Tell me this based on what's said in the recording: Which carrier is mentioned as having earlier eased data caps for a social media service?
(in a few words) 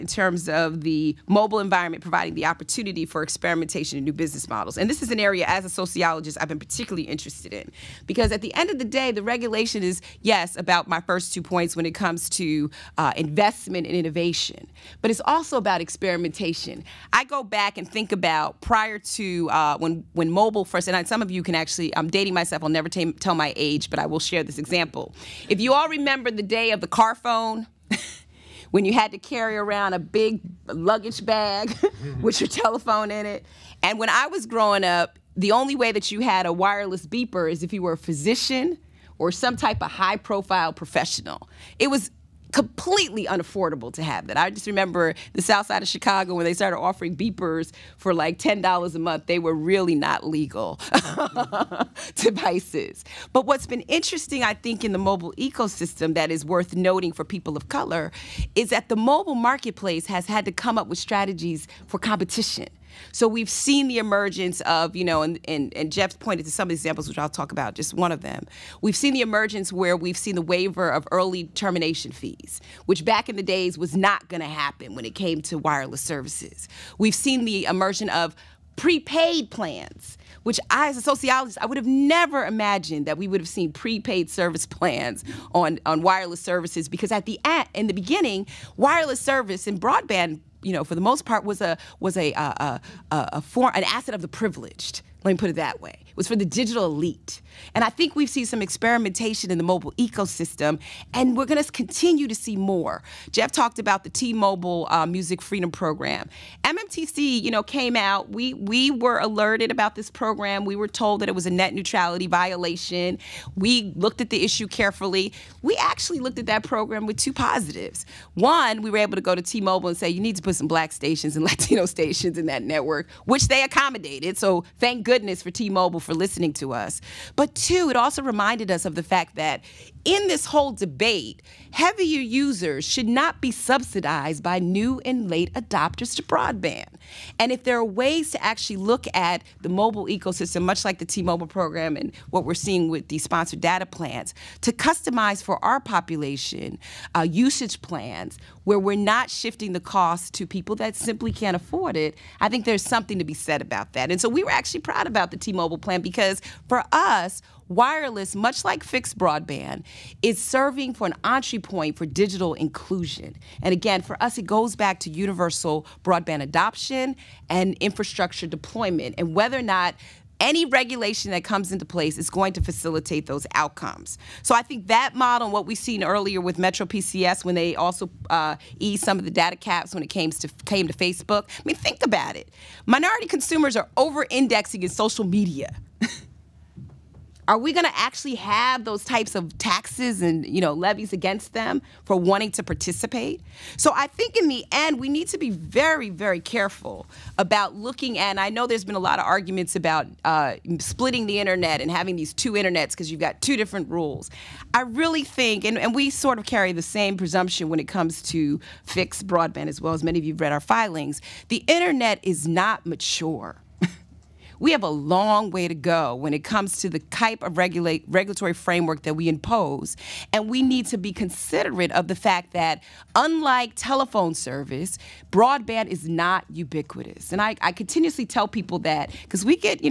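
MetroPCS.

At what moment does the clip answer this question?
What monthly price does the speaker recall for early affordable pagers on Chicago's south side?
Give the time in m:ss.
0:48.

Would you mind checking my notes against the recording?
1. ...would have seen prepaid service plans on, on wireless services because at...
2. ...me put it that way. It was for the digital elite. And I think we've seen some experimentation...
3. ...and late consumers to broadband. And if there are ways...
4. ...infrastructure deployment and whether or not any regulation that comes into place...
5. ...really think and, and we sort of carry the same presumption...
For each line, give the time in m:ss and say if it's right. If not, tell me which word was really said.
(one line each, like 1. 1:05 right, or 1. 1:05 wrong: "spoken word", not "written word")
1. 1:23 right
2. 1:35 right
3. 2:15 wrong: "adopters", not "consumers"
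4. 2:47 right
5. 3:24 right.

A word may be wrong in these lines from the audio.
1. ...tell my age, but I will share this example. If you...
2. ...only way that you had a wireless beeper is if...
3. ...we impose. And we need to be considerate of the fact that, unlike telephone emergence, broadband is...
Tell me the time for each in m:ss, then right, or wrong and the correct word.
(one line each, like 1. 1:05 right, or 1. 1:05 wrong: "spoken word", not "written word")
1. 0:23 right
2. 0:35 right
3. 3:39 wrong: "service", not "emergence".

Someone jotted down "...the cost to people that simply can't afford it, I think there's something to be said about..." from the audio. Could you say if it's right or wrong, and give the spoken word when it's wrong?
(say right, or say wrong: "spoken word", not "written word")
right.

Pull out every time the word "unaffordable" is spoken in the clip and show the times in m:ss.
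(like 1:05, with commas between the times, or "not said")
0:43.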